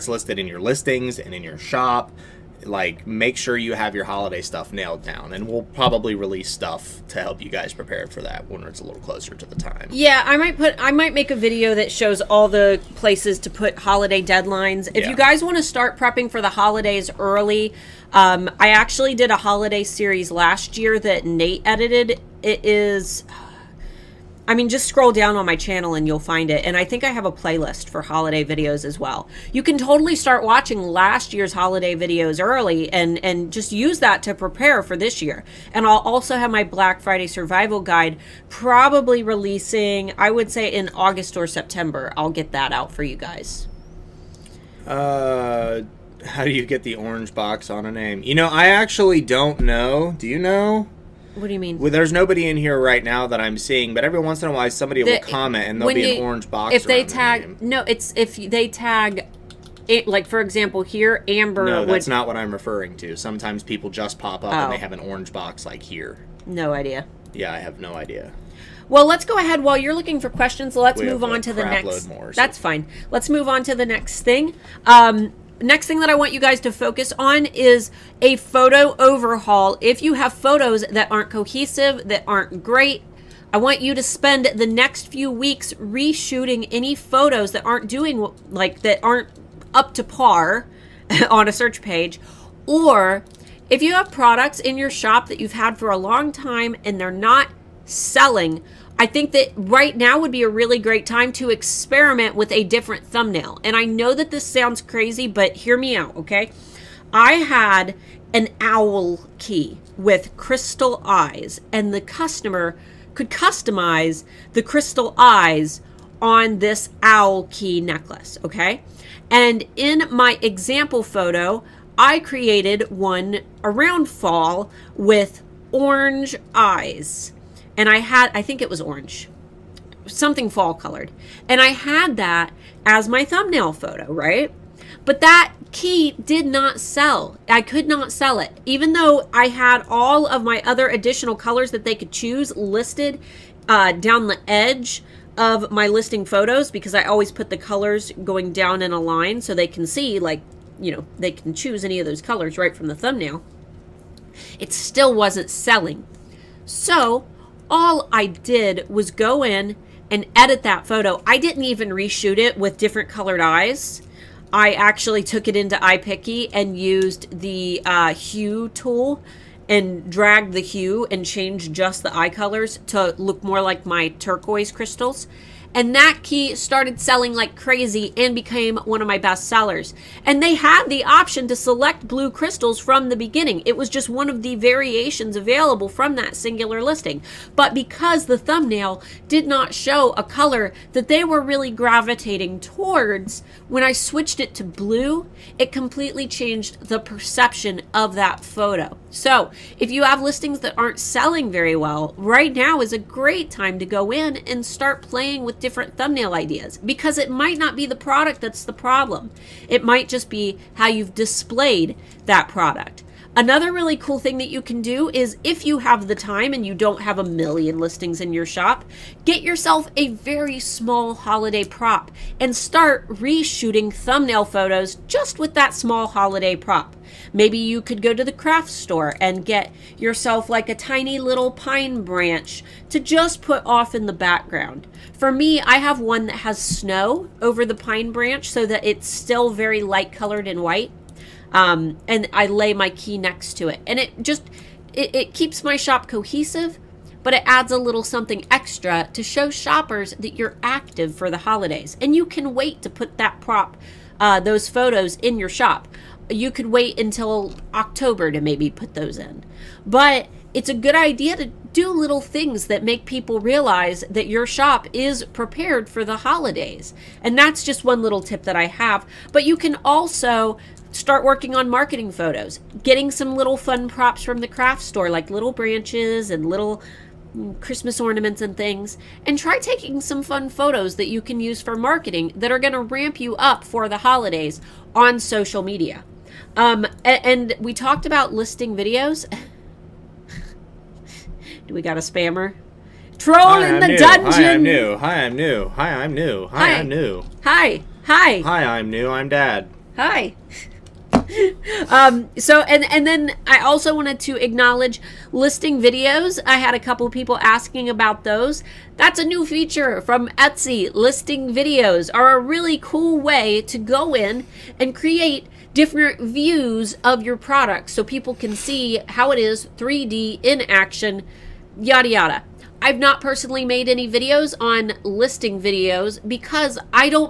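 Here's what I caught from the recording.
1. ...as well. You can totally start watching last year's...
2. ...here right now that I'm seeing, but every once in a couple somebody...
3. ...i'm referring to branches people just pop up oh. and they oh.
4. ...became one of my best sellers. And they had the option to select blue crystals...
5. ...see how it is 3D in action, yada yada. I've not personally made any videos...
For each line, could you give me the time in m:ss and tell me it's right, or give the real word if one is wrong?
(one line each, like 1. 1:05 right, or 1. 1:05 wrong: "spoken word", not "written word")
1. 0:28 right
2. 0:52 wrong: "while", not "couple"
3. 1:02 wrong: "sometimes", not "branches"
4. 2:58 right
5. 5:18 right.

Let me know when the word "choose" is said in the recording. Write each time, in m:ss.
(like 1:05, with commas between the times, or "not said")
2:22, 2:31.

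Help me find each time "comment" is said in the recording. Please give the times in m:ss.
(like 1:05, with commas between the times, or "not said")
0:55.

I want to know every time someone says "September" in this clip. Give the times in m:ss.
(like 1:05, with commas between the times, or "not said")
0:41.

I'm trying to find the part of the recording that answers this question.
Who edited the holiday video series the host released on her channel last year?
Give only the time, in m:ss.
0:21.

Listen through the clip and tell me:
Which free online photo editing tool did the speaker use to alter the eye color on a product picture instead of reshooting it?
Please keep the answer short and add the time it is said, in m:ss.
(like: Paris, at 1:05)
iPiccy, at 2:45.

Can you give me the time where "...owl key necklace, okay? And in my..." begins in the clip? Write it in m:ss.
1:57.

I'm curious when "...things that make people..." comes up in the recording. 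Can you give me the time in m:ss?
4:22.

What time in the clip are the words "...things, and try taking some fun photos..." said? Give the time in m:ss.
4:38.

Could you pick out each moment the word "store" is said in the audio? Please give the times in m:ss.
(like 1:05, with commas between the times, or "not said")
3:48, 4:34.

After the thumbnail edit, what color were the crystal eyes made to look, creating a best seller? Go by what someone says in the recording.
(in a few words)
turquoise.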